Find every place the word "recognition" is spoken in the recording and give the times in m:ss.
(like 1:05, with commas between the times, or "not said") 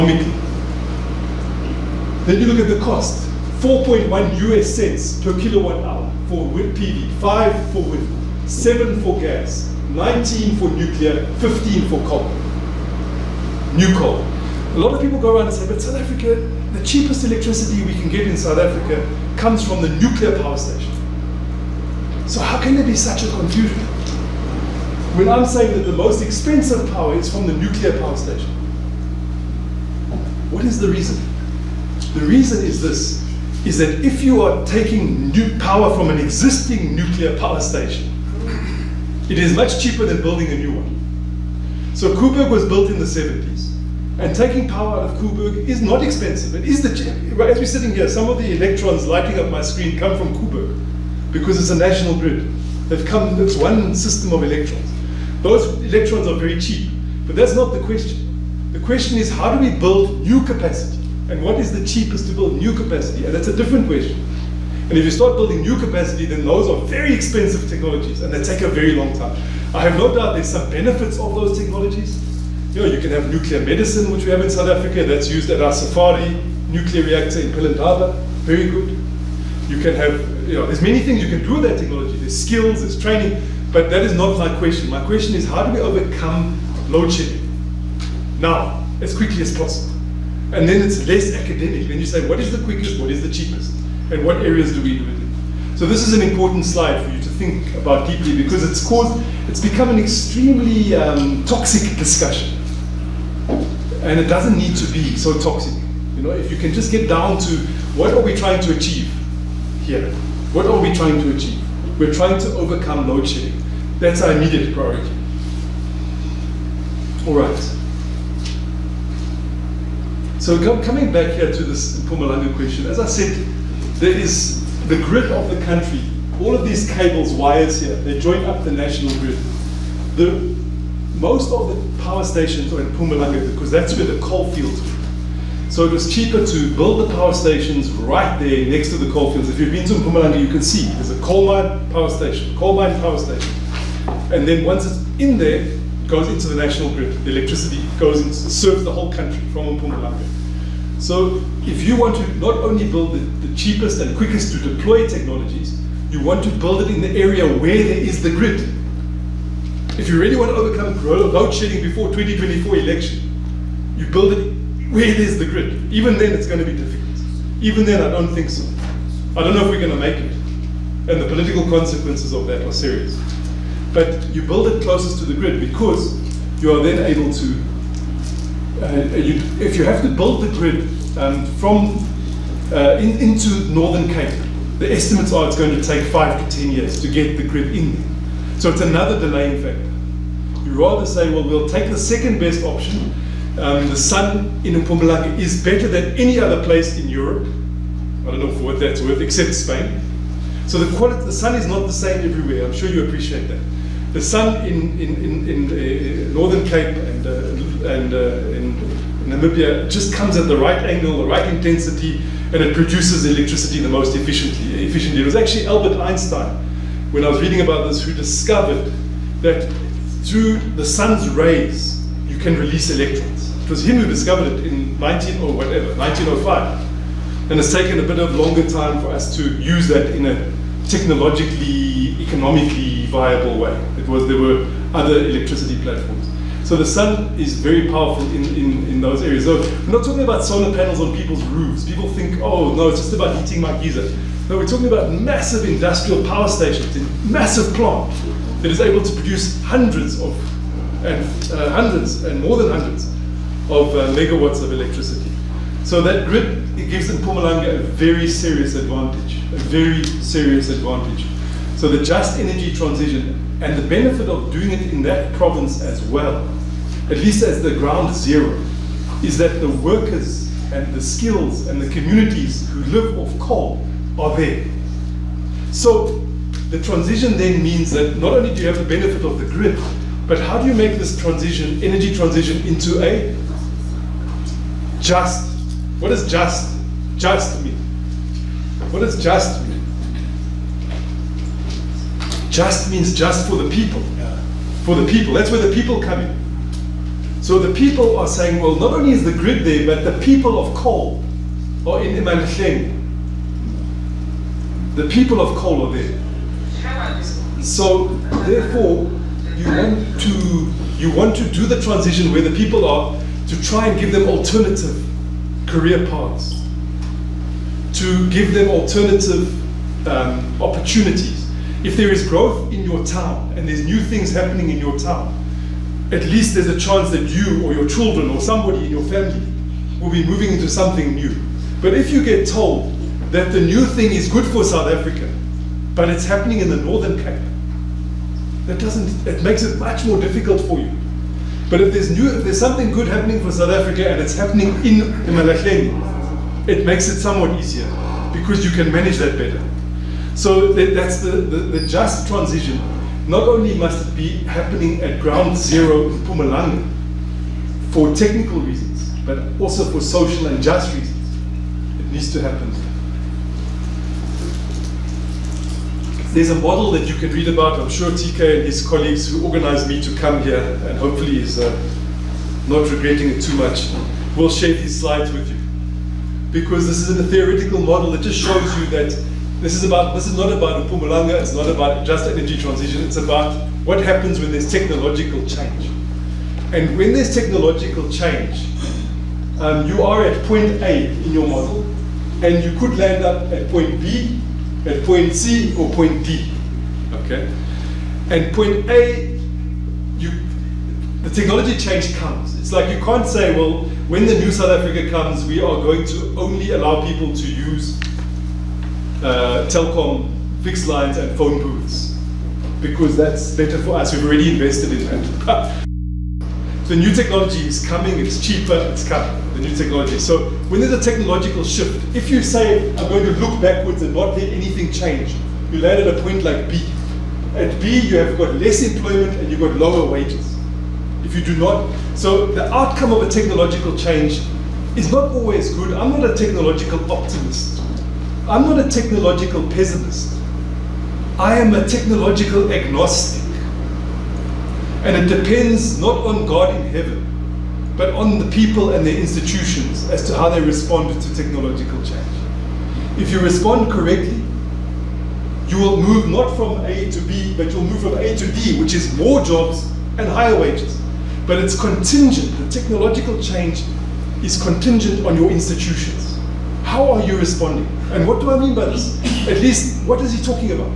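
not said.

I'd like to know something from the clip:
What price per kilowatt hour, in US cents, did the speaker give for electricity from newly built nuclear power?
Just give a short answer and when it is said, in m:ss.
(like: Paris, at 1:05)
19, at 0:09.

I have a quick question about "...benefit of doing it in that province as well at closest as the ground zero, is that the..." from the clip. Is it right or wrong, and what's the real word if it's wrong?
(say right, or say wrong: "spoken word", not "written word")
wrong: "least", not "closest".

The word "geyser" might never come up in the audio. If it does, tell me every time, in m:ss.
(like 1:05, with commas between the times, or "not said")
4:03.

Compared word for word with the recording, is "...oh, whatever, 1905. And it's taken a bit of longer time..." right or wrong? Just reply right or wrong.
right.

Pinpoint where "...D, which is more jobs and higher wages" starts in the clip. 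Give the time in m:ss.
7:38.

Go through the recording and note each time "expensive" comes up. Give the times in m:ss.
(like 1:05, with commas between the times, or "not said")
0:26, 0:46, 1:07.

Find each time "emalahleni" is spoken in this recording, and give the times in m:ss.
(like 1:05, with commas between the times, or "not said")
5:02, 5:45.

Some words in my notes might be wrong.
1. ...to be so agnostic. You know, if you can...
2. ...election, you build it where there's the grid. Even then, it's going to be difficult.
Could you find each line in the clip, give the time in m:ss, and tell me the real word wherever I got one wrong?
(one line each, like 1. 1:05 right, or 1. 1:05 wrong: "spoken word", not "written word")
1. 1:44 wrong: "toxic", not "agnostic"
2. 2:42 right.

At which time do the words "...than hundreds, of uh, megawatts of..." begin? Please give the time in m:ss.
4:12.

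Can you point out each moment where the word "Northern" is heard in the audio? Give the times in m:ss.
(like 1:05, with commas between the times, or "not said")
3:03, 3:26, 5:36.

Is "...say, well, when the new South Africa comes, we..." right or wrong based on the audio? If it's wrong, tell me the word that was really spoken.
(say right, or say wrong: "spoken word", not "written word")
right.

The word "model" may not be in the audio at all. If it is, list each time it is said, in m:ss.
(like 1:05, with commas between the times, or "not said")
6:06, 6:17, 6:31.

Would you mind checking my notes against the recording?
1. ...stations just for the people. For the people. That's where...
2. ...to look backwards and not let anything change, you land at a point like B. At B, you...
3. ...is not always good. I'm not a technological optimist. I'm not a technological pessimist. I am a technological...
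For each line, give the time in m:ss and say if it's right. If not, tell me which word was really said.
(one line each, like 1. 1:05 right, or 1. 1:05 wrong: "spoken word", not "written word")
1. 4:52 wrong: "means", not "stations"
2. 7:03 right
3. 7:14 right.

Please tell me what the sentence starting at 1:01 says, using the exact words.
And what is the cheapest to build new capacity?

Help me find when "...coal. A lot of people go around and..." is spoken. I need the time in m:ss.
0:13.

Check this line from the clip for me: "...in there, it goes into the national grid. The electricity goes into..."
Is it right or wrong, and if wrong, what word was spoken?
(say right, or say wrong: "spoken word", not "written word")
right.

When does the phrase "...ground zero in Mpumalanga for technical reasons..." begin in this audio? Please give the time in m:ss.
5:55.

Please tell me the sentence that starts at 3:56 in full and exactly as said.
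So the sun is very powerful in, in, in those areas.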